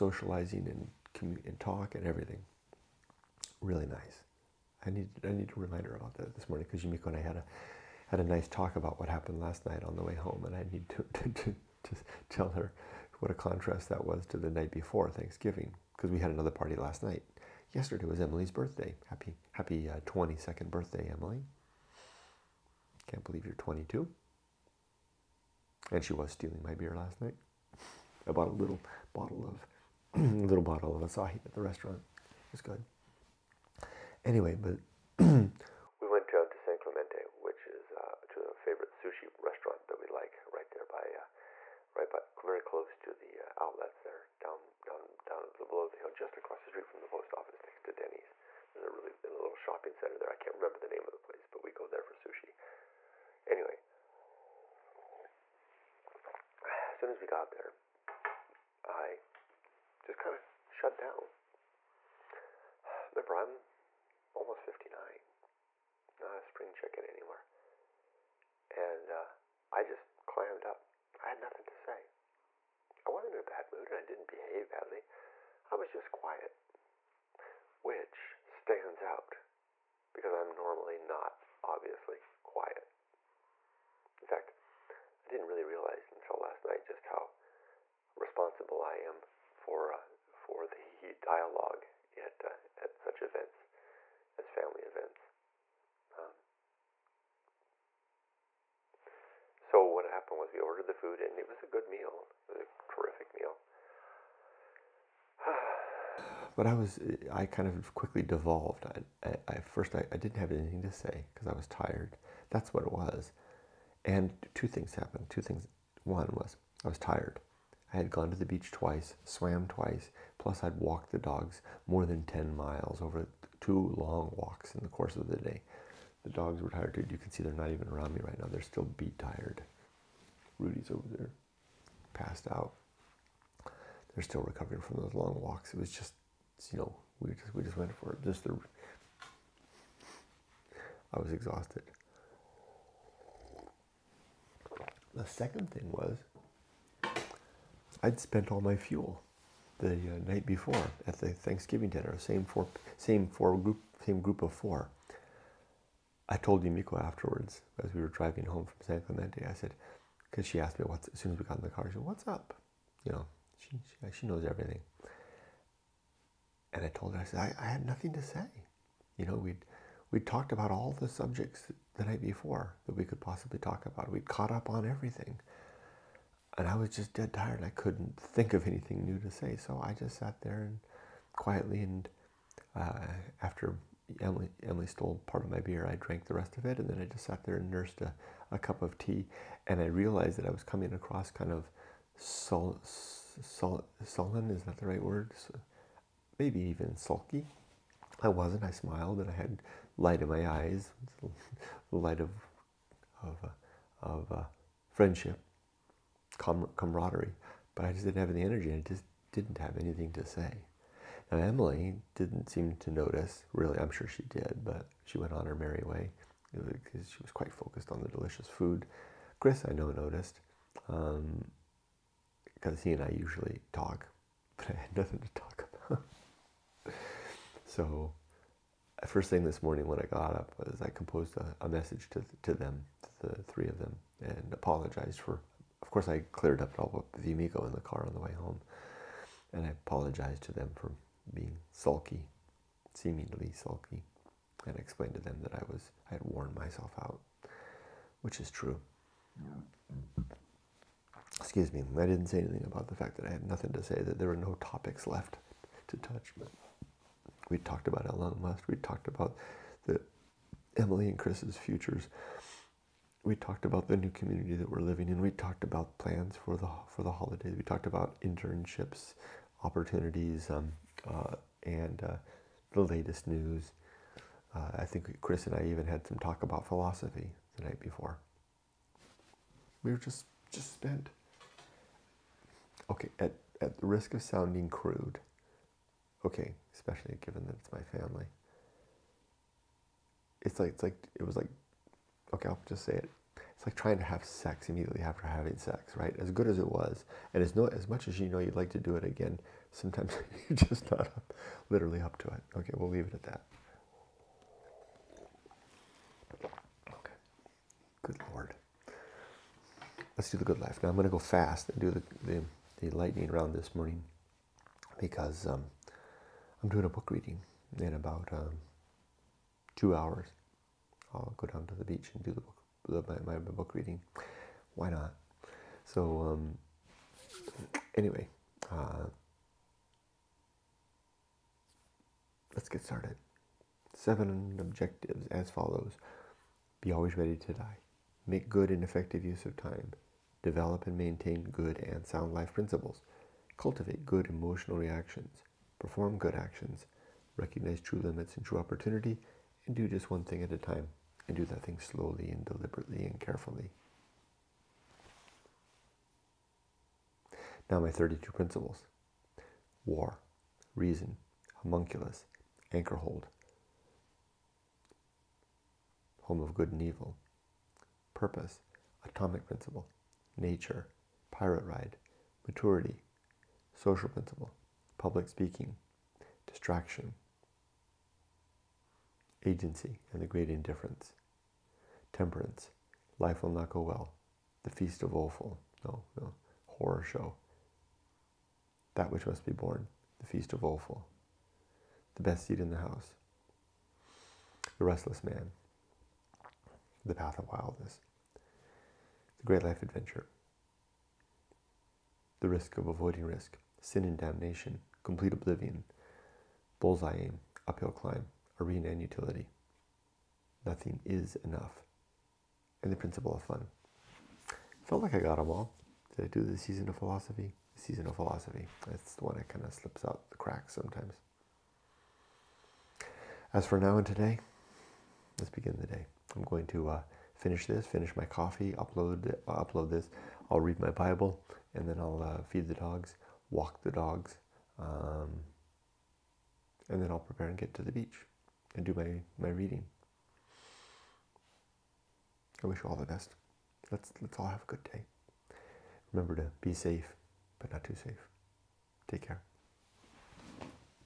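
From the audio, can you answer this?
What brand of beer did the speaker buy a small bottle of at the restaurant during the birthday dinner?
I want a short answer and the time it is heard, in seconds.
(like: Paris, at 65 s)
Asahi, at 31 s.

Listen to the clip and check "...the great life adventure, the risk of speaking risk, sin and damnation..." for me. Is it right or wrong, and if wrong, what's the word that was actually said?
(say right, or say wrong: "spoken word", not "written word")
wrong: "avoiding", not "speaking".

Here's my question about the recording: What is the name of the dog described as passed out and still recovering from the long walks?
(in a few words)
Rudy.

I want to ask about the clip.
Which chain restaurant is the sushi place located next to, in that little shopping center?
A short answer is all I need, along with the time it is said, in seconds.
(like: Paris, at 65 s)
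Denny's, at 47 s.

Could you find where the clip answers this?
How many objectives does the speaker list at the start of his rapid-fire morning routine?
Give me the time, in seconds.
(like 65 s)
333 s.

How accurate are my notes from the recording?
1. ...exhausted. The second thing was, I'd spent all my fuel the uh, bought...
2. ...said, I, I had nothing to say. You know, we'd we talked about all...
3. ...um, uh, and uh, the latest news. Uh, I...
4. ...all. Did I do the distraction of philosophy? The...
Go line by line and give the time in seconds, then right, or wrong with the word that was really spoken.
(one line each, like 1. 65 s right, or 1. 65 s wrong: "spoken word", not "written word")
1. 141 s wrong: "night", not "bought"
2. 167 s right
3. 270 s right
4. 415 s wrong: "season", not "distraction".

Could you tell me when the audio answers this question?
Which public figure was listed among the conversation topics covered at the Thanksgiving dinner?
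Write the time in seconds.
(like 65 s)
258 s.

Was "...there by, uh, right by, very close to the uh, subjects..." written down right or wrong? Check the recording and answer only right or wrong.
wrong.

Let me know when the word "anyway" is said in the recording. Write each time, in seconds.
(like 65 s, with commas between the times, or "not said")
34 s, 53 s, 327 s.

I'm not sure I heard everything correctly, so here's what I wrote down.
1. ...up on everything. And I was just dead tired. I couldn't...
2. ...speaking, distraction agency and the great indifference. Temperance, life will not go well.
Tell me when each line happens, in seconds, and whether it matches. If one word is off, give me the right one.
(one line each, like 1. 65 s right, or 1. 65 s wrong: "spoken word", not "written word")
1. 174 s right
2. 375 s right.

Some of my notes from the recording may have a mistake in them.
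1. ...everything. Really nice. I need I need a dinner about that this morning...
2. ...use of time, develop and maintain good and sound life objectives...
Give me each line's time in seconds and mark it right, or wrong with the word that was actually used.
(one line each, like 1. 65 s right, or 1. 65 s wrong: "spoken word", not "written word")
1. 2 s wrong: "reminder", not "dinner"
2. 339 s wrong: "principles", not "objectives".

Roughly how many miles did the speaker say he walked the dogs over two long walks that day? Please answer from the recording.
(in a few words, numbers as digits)
10 miles.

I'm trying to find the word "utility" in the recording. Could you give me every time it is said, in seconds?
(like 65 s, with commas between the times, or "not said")
409 s.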